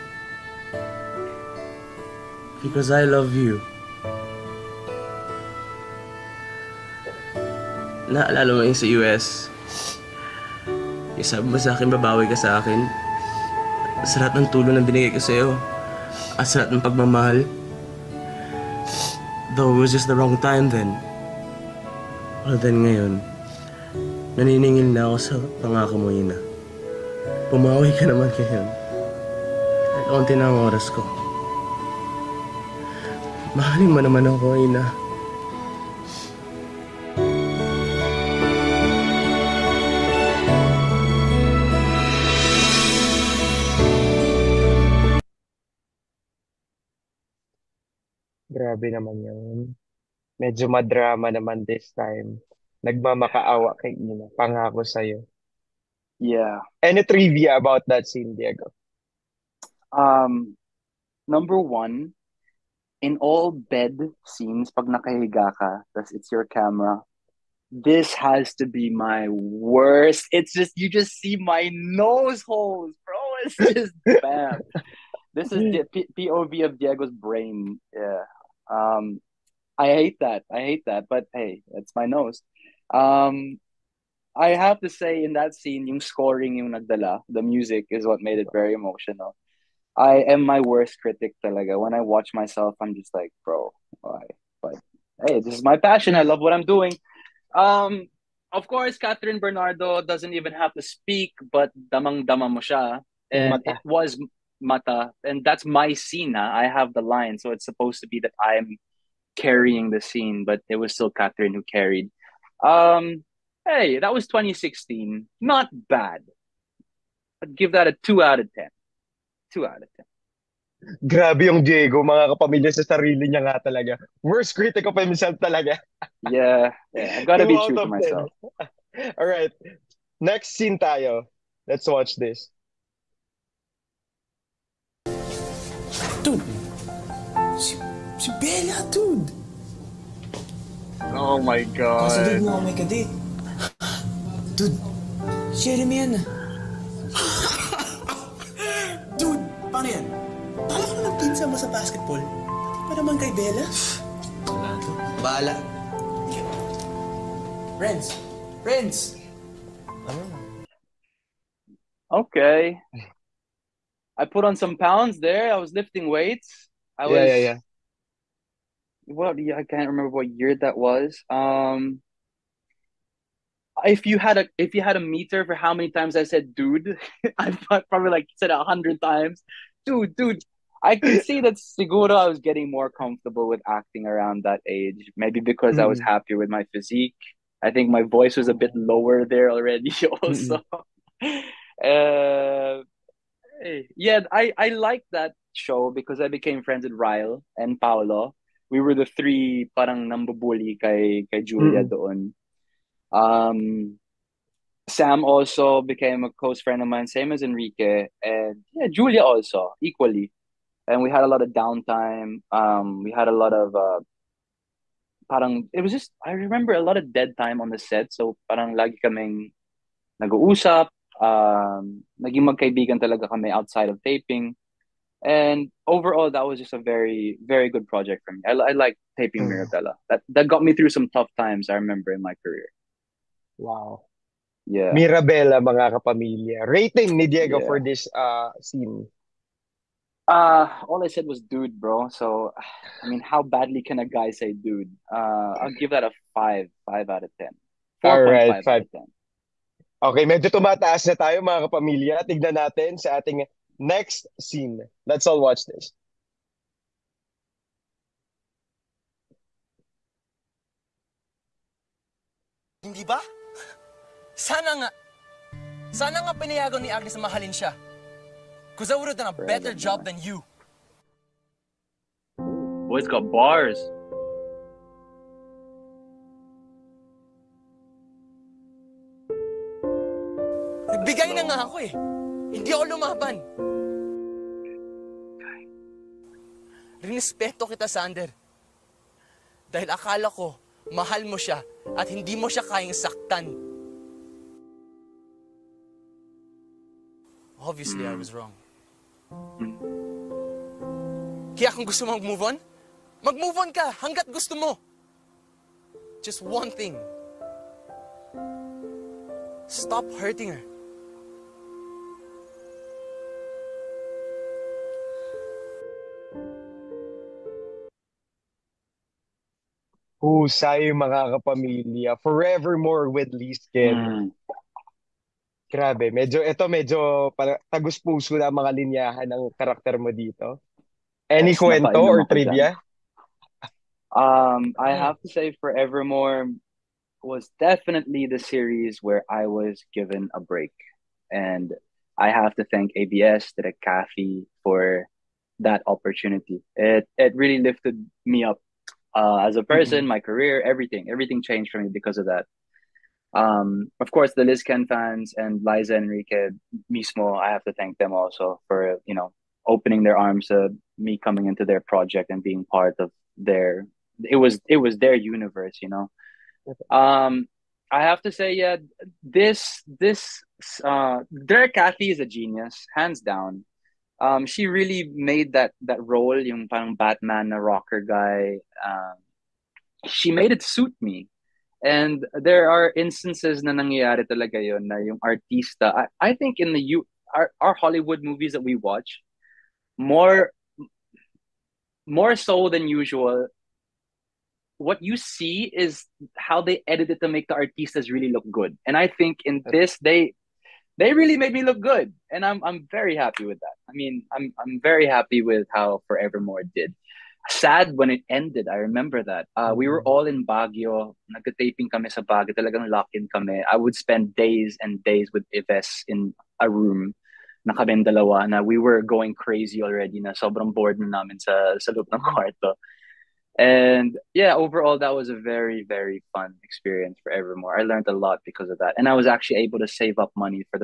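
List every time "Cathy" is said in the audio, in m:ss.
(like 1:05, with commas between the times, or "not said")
5:43, 6:11.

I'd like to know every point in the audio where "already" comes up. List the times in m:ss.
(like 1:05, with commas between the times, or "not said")
3:09, 6:59.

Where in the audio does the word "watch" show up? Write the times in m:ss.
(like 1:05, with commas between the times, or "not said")
1:32, 2:11, 4:15, 6:28.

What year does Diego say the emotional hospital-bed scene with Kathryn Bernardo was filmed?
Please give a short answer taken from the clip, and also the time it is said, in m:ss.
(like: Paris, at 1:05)
2016, at 1:54.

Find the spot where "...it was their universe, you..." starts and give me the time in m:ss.
6:04.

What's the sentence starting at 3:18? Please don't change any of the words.
we were the three parang nambubuli kay kay Julia mm.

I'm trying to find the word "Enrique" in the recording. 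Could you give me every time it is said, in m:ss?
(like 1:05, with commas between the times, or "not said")
3:27, 5:55.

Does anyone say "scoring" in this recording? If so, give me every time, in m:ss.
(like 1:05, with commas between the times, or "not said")
1:26.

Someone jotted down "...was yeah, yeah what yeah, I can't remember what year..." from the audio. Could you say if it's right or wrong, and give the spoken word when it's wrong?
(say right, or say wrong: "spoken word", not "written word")
right.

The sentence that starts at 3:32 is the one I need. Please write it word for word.
Um, we had a lot of uh, parang it was just I remember a lot of dead time on the set.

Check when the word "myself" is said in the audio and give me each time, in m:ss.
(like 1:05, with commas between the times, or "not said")
1:32, 2:07.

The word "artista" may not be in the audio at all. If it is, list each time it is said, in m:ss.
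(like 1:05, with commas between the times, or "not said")
6:25, 6:37.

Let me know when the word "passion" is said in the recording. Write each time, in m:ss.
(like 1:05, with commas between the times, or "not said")
1:35.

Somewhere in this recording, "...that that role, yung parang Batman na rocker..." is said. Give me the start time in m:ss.
6:15.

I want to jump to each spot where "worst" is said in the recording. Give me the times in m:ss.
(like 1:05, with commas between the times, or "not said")
1:09, 1:30, 2:04.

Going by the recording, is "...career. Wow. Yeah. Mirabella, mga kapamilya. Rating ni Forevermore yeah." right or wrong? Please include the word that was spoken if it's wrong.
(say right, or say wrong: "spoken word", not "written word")
wrong: "Diego", not "Forevermore".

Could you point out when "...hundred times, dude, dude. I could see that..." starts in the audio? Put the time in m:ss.
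2:58.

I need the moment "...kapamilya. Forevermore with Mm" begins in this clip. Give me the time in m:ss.
5:21.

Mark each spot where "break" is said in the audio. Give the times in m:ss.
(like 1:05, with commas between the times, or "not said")
5:40.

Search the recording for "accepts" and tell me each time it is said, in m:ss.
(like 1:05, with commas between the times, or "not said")
not said.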